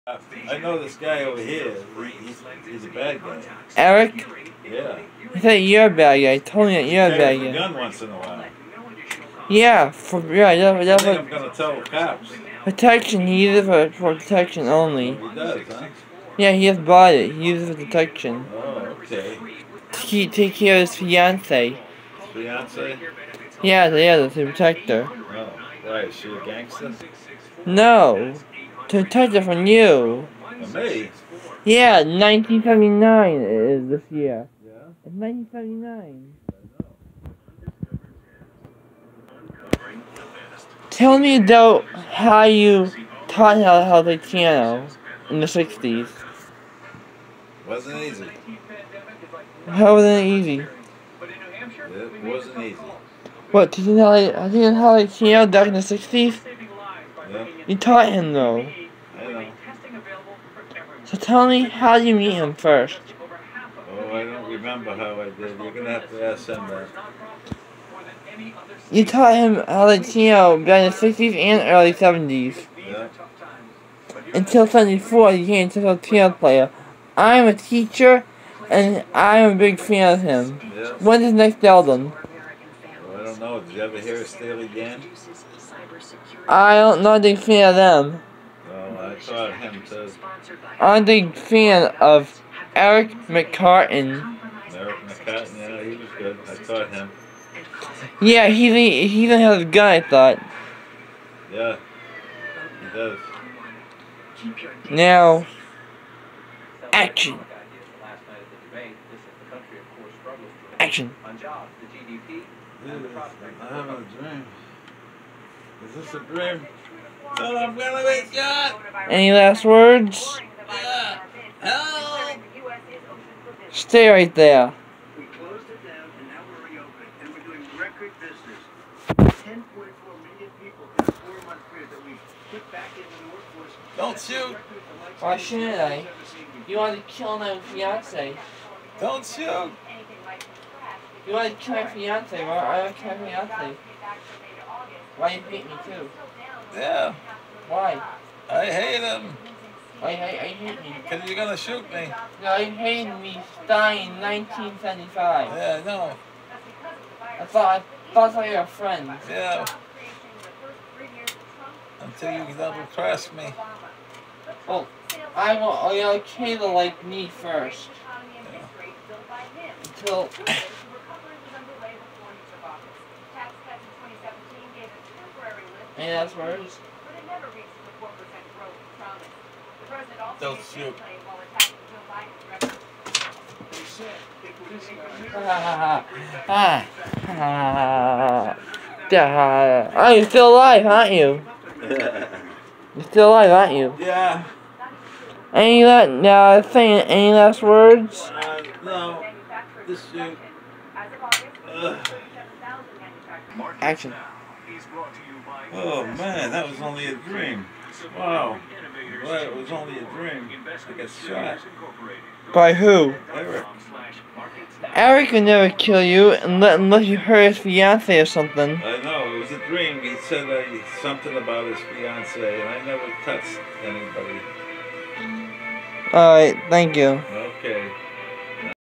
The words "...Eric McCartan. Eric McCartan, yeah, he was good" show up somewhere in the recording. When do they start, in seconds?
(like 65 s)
92 s.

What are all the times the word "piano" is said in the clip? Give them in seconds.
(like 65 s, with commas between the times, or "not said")
44 s, 55 s.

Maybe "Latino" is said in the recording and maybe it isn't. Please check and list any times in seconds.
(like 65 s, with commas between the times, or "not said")
69 s, 75 s.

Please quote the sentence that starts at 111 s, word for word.
On jobs, the GDP, and the prospect.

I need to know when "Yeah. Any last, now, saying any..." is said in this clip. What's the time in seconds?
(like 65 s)
193 s.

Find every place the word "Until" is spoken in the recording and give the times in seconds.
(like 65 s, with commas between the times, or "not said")
74 s, 162 s, 169 s.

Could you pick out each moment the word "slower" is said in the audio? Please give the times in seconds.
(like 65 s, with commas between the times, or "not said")
not said.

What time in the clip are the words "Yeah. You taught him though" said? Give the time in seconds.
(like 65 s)
57 s.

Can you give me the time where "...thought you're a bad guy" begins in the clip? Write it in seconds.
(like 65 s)
5 s.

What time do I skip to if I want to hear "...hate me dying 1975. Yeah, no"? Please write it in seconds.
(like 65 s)
152 s.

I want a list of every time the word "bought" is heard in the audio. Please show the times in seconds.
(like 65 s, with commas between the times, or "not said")
16 s.